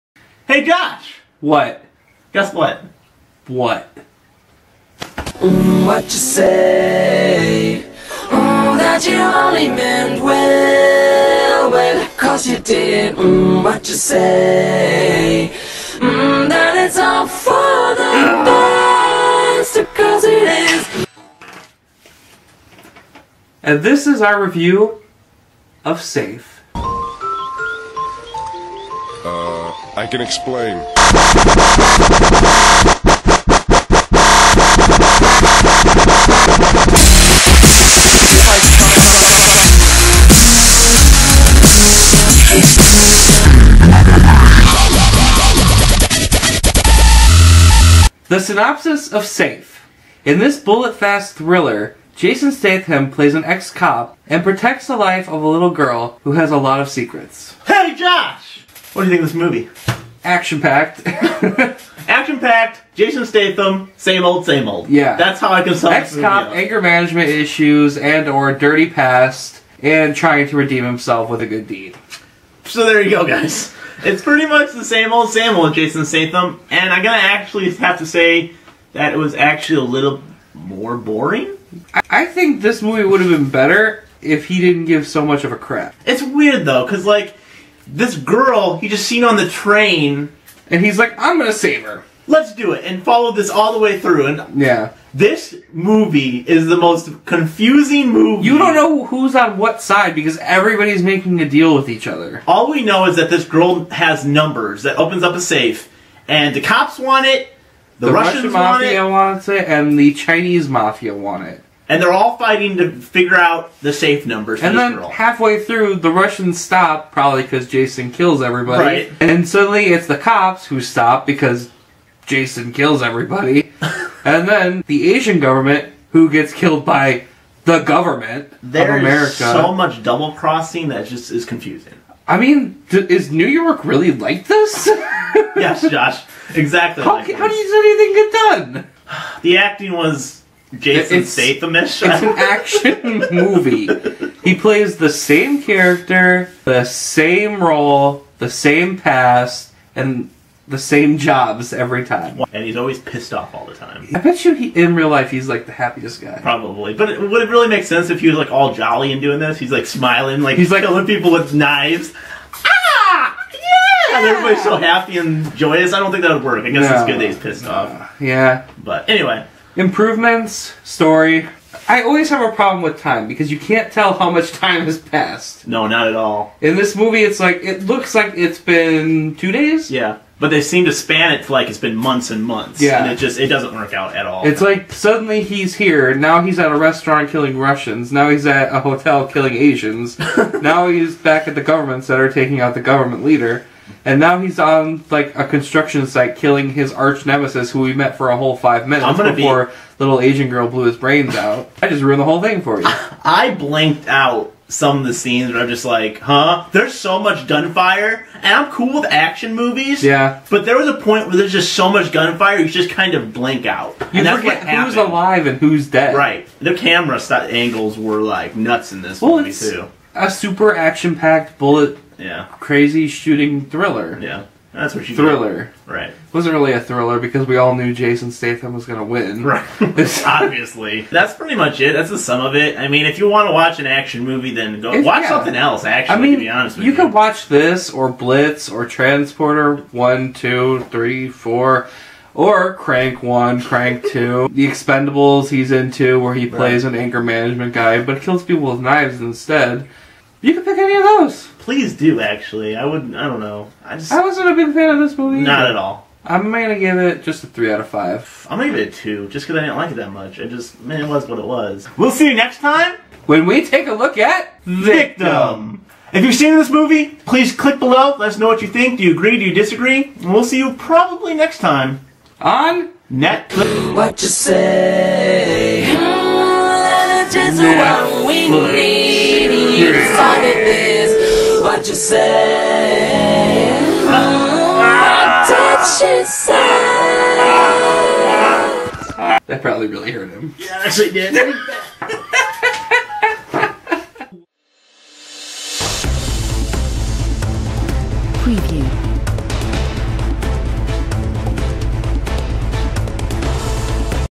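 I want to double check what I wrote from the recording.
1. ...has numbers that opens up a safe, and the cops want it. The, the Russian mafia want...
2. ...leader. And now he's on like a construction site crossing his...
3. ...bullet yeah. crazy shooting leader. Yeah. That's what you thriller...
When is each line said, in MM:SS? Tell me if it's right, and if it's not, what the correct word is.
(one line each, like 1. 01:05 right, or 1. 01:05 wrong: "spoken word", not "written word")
1. 01:43 right
2. 03:13 wrong: "killing", not "crossing"
3. 03:41 wrong: "thriller", not "leader".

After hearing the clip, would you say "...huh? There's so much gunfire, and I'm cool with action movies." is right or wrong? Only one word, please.
right.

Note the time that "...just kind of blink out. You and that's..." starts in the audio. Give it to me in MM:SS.
03:32.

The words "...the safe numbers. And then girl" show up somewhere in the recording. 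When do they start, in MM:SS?
01:53.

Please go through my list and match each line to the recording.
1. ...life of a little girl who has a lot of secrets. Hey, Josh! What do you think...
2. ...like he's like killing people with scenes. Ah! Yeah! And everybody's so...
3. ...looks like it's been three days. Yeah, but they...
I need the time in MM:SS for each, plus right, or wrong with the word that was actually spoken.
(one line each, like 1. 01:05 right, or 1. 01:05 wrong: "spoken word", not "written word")
1. 00:54 right
2. 02:40 wrong: "knives", not "scenes"
3. 02:57 wrong: "two", not "three".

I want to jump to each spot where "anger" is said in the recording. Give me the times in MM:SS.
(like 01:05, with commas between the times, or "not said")
01:06, 04:06.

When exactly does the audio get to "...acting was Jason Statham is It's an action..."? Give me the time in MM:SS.
02:19.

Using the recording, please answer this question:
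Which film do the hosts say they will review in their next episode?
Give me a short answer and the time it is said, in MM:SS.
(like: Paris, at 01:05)
Victim, at 04:24.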